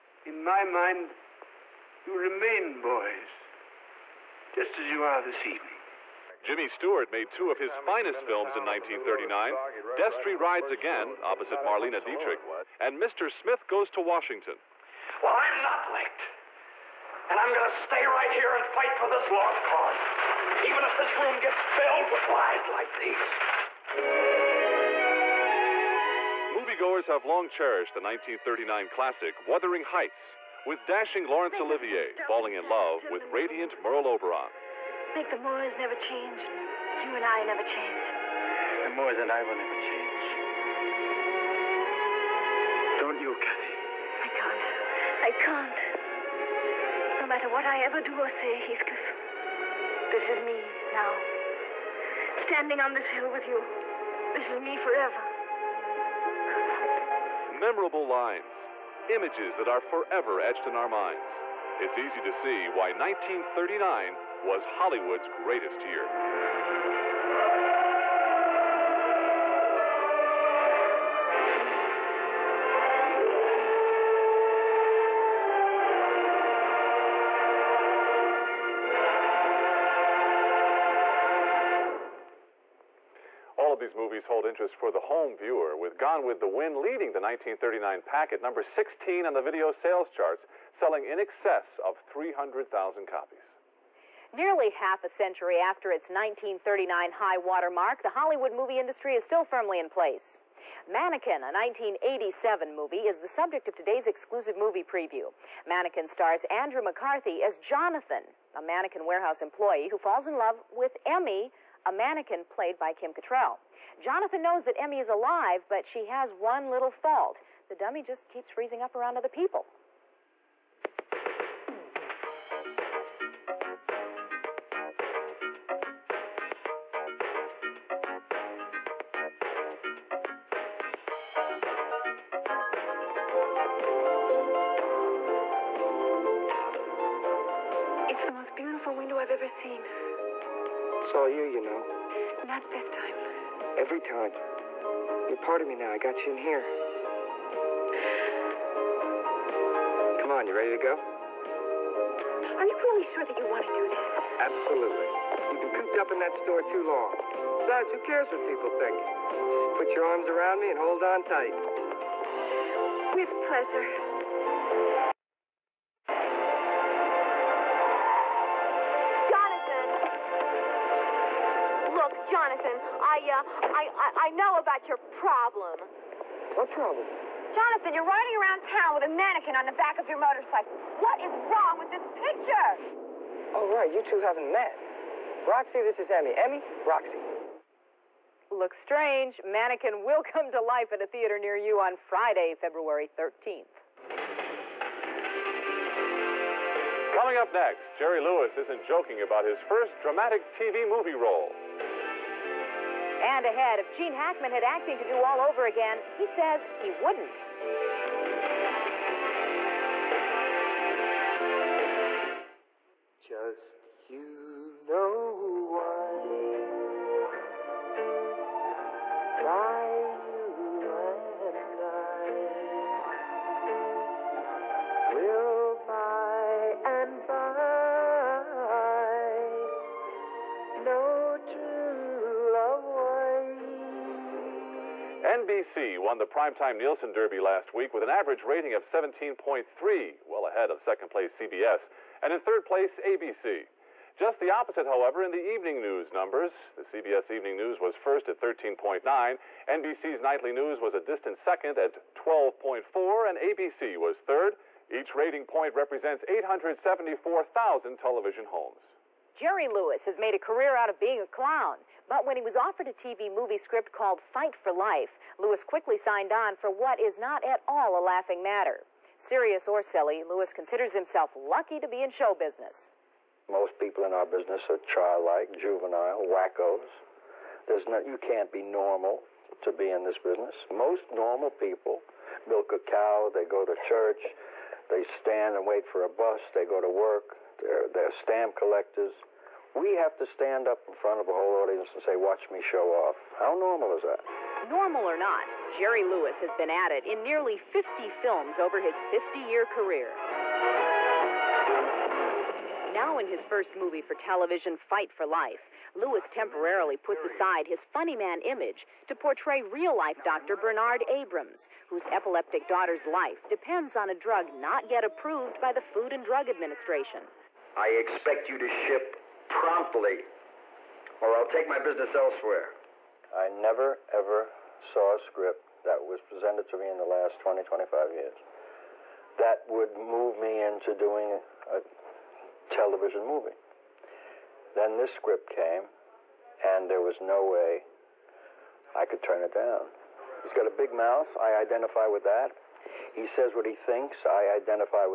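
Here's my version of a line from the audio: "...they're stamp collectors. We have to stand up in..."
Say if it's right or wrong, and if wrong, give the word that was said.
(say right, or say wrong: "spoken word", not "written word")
right.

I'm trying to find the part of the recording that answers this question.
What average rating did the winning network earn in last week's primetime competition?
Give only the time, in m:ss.
3:58.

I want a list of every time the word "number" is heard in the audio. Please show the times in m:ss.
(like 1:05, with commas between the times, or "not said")
1:28, 4:06.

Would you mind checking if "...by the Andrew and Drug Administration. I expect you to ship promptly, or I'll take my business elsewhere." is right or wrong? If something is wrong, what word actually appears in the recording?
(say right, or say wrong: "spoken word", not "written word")
wrong: "Food", not "Andrew".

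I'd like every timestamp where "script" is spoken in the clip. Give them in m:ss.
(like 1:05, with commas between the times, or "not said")
4:23, 5:25, 5:35.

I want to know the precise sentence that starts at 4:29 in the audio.
Serious or silly, Lewis considers himself lucky to be in show business.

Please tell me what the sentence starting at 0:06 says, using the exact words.
Jimmy Stewart made two of his finest films in 1939, Destry Rides Again, opposite Marlene Dietrich, and Mr.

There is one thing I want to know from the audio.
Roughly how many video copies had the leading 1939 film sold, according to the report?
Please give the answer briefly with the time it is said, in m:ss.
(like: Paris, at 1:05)
300,000, at 1:32.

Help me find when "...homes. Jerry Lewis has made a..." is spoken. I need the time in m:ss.
4:18.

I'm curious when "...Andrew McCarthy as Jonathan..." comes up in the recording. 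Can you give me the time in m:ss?
1:46.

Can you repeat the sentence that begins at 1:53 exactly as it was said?
Jonathan knows that Emmy is alive, but she has one little fault.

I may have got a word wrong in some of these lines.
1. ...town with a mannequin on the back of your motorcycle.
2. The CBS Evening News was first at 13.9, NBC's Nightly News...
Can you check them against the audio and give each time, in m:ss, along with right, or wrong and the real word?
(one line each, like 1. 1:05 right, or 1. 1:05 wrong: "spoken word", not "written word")
1. 2:58 right
2. 4:06 right.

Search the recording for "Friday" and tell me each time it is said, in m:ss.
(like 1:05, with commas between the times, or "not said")
3:11.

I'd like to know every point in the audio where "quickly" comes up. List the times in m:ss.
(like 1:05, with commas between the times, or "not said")
4:25.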